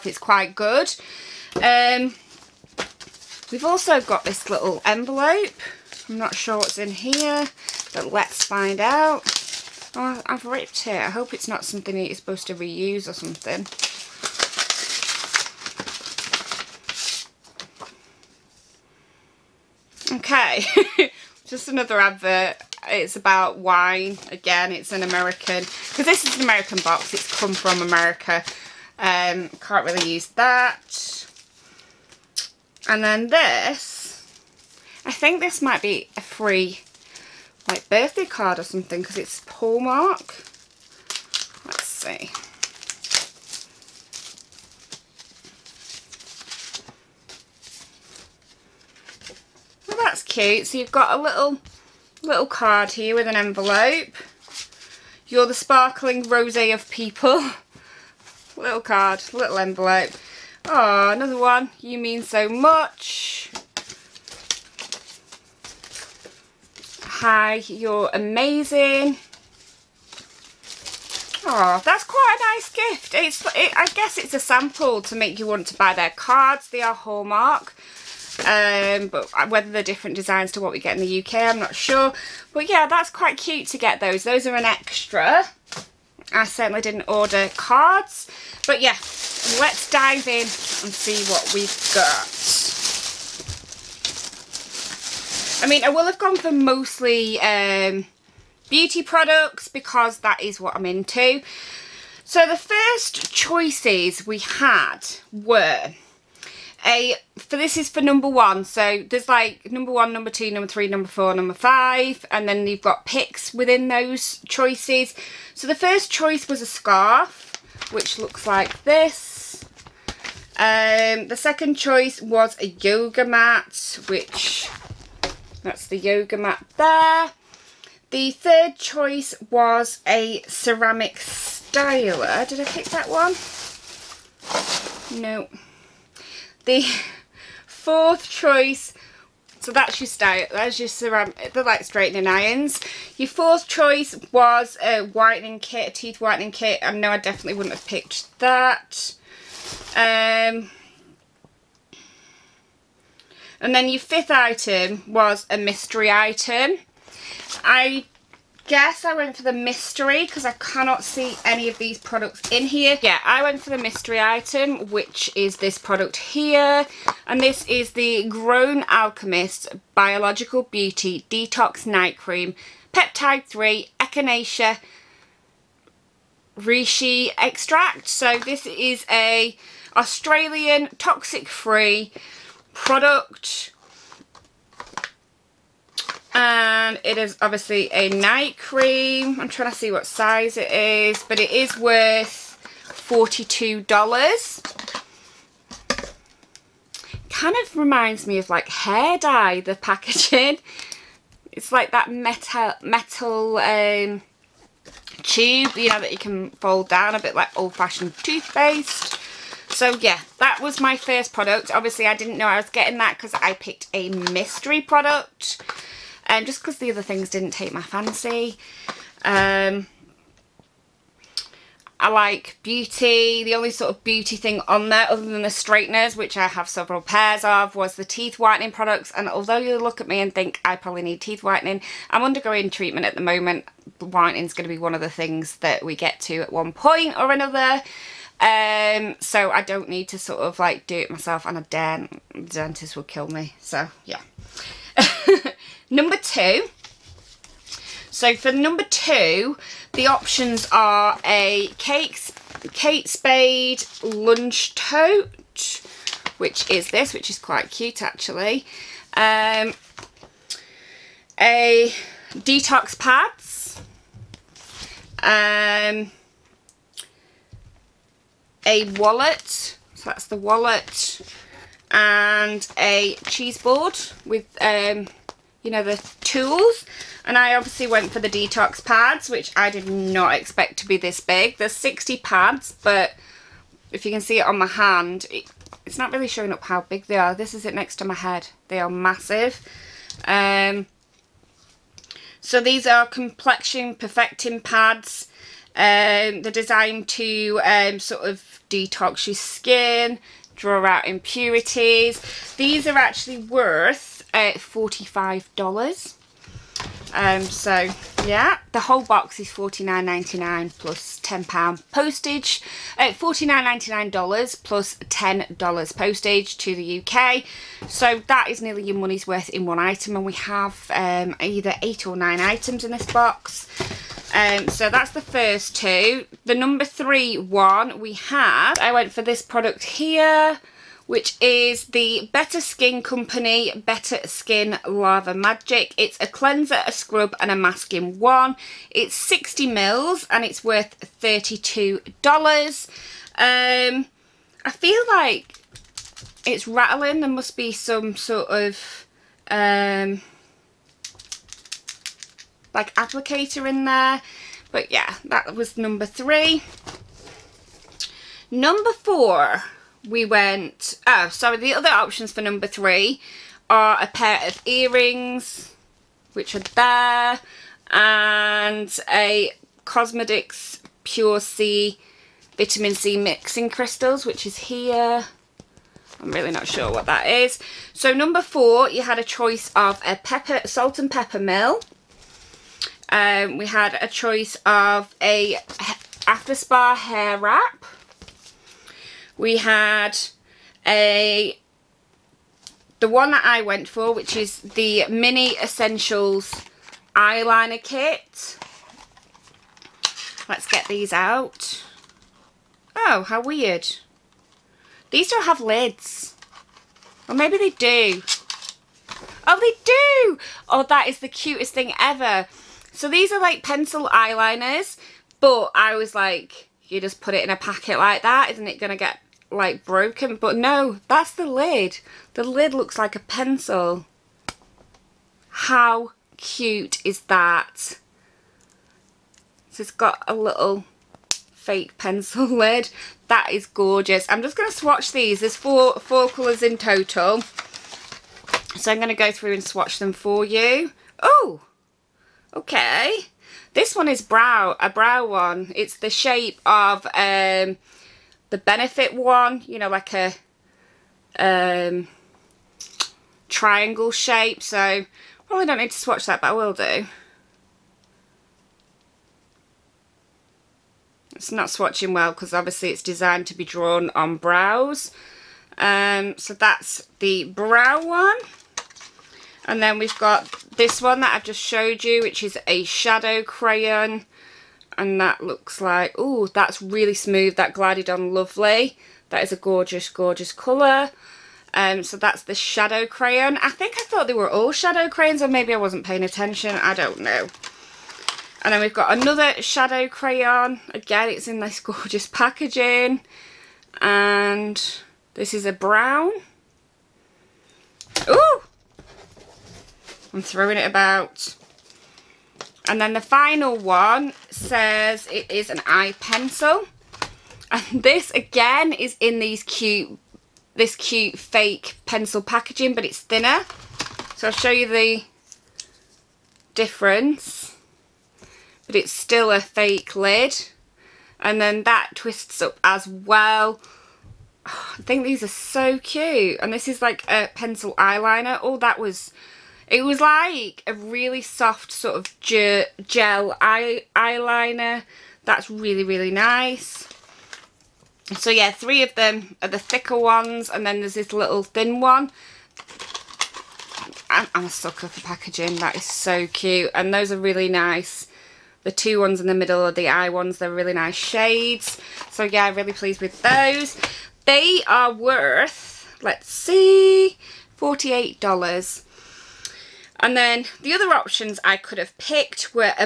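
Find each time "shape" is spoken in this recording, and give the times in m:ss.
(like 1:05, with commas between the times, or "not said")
7:26, 7:34.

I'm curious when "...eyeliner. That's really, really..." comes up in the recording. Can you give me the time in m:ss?
8:54.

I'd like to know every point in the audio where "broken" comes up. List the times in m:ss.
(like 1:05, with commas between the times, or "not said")
6:59.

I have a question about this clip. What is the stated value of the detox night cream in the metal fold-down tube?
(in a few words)
$42.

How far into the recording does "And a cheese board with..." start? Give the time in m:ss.
4:31.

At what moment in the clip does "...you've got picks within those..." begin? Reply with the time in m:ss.
1:52.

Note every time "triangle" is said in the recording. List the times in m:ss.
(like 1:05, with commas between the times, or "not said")
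7:33.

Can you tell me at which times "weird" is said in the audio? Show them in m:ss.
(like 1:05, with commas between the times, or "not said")
6:43.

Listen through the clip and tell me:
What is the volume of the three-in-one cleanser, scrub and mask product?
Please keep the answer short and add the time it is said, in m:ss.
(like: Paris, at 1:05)
60 ml, at 5:39.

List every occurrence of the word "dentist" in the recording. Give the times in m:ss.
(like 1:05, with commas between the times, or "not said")
4:02.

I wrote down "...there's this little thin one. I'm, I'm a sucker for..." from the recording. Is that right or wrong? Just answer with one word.
right.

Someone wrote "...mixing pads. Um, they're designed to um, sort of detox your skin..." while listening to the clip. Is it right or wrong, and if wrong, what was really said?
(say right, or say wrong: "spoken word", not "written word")
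wrong: "perfecting", not "mixing".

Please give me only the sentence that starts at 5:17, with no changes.
So that is nearly your money's worth in one item and we have um, either eight or nine items in this box.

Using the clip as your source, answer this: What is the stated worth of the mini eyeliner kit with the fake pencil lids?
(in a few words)
$48.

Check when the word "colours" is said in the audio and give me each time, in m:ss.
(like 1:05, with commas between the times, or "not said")
7:16, 8:00.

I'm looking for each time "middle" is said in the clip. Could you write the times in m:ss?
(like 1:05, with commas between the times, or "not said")
9:09.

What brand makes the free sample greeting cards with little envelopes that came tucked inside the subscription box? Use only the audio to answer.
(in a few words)
Hallmark.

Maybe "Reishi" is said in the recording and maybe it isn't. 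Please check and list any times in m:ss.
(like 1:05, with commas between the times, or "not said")
2:56.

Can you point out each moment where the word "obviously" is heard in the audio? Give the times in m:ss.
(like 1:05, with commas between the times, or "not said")
3:07, 3:31, 4:37, 7:42.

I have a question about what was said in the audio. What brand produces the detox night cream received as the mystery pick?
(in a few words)
Grown Alchemist.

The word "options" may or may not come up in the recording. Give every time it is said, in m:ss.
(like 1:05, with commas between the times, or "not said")
4:10, 6:01, 9:21.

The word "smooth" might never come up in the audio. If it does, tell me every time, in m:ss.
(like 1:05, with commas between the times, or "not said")
7:57.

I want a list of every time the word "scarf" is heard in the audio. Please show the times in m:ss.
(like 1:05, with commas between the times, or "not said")
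1:56.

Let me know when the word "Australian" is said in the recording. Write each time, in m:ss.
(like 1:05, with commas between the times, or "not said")
2:59.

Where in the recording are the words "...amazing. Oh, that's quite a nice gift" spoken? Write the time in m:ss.
1:08.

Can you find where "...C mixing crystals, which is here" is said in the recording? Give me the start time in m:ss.
6:12.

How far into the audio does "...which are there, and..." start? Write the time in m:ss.
6:06.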